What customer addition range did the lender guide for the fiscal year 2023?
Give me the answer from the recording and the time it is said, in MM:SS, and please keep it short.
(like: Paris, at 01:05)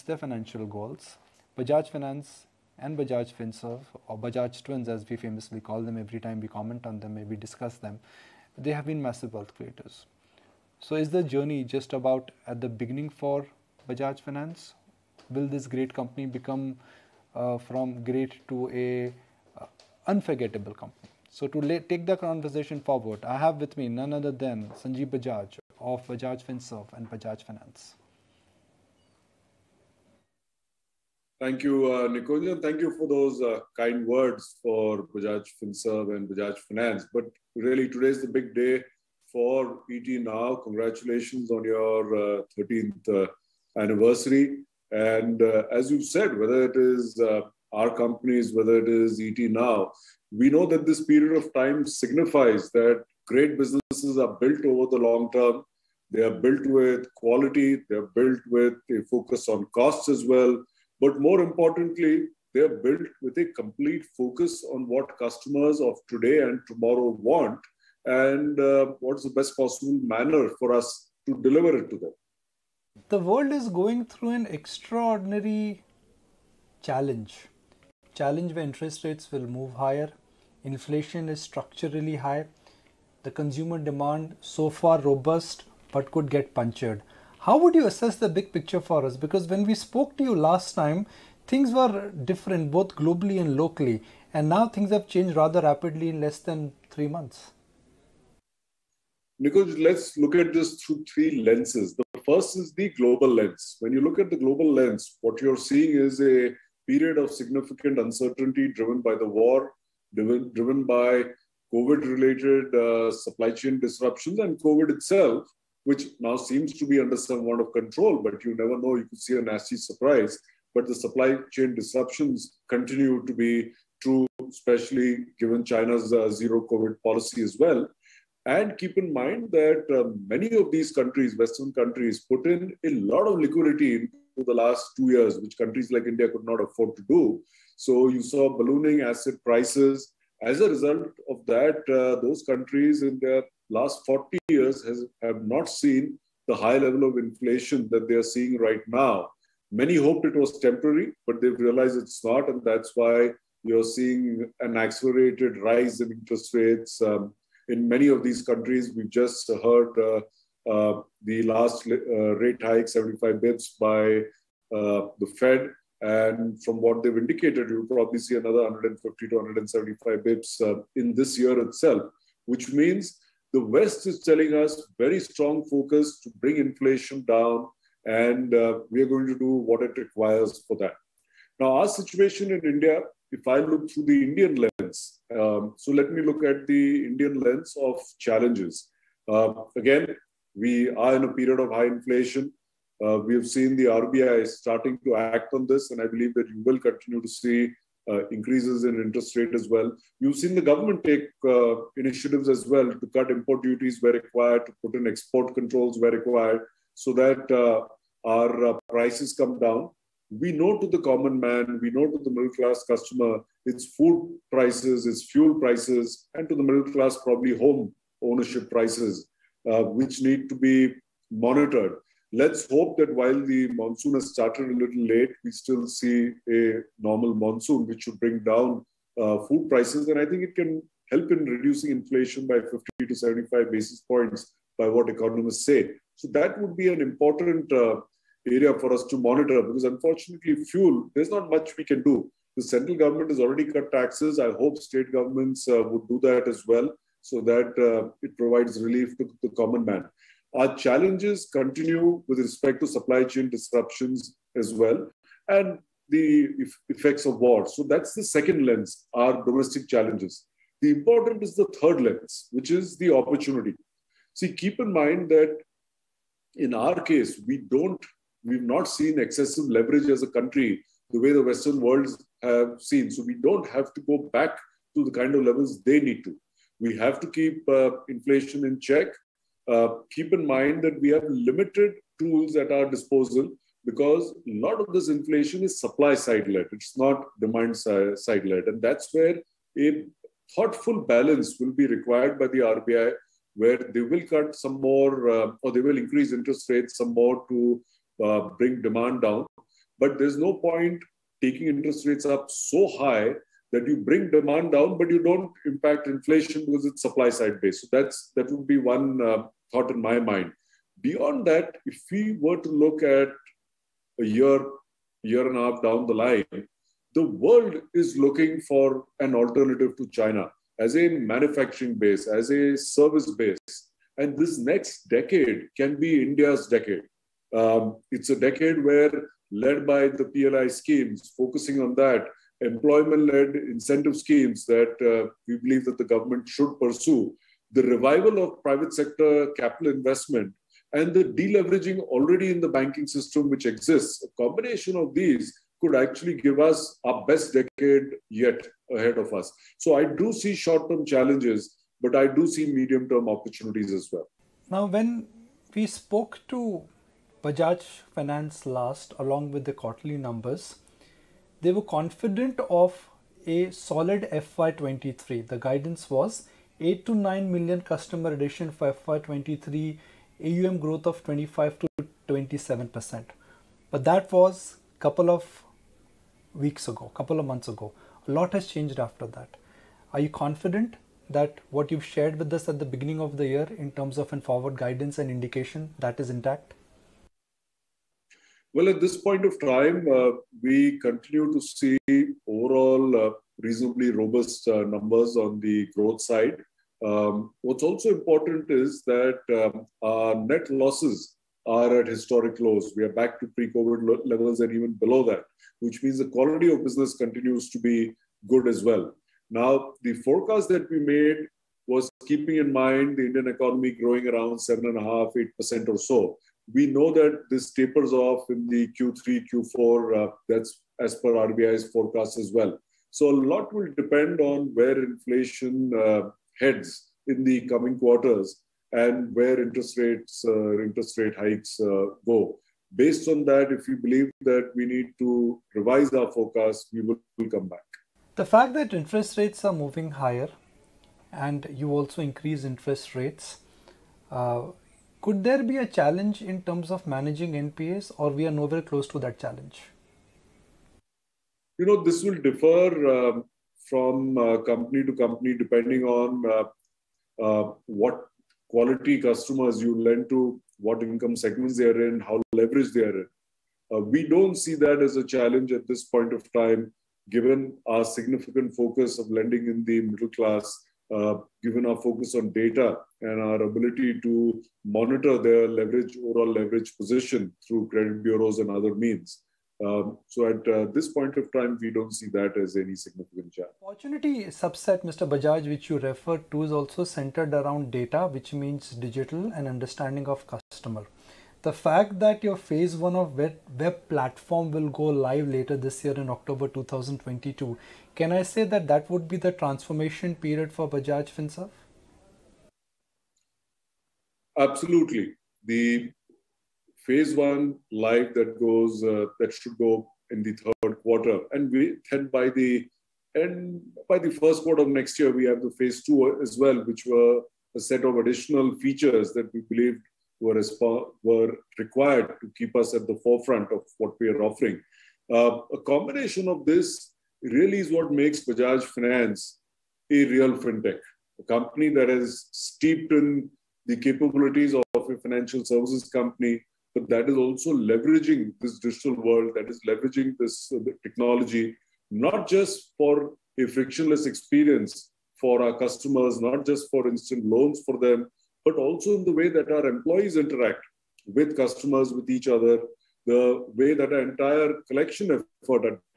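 8 to 9 million, at 06:06.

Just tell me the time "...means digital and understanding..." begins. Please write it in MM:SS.
08:08.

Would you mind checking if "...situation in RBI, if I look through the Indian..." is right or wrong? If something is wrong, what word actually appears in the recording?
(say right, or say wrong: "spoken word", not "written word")
wrong: "India", not "RBI".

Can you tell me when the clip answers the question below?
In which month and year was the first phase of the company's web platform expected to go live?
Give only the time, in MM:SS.
08:16.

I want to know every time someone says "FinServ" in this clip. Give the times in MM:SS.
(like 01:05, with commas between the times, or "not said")
00:03, 00:26, 00:35, 08:21.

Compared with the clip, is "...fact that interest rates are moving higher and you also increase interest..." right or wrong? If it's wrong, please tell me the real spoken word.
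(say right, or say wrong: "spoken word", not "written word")
right.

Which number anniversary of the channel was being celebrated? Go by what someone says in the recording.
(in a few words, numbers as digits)
13th.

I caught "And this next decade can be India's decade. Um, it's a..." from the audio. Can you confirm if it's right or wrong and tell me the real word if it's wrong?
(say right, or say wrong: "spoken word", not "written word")
right.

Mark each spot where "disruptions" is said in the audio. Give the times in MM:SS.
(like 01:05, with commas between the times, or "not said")
01:53, 02:01, 04:13.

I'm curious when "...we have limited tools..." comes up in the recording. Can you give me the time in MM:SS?
04:41.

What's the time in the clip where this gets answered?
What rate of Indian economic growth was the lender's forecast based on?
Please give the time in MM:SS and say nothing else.
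06:54.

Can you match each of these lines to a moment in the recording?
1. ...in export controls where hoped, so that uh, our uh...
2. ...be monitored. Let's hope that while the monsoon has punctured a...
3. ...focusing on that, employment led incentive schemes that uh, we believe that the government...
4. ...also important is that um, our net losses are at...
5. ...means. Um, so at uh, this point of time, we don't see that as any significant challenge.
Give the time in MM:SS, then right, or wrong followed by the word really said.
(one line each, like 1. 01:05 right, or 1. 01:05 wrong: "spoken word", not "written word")
1. 03:24 wrong: "required", not "hoped"
2. 03:40 wrong: "started", not "punctured"
3. 05:31 right
4. 06:37 right
5. 07:58 right.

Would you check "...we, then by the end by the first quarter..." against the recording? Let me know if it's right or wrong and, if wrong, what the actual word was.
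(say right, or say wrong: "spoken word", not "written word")
right.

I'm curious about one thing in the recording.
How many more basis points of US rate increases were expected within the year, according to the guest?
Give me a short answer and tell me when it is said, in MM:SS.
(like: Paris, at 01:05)
150 to 175, at 02:48.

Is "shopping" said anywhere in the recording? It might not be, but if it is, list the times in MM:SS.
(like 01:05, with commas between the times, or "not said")
not said.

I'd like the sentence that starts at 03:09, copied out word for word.
Uh, again, we are in a period of high inflation.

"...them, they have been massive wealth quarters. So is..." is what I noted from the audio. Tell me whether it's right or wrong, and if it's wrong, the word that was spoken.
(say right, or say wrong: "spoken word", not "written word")
wrong: "creators", not "quarters".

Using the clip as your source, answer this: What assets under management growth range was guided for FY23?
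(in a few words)
25 to 27%.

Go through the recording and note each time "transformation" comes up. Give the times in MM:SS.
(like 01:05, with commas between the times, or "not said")
08:19.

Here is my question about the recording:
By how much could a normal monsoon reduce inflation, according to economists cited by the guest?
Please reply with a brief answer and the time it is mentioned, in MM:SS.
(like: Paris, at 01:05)
50 to 75 basis points, at 03:52.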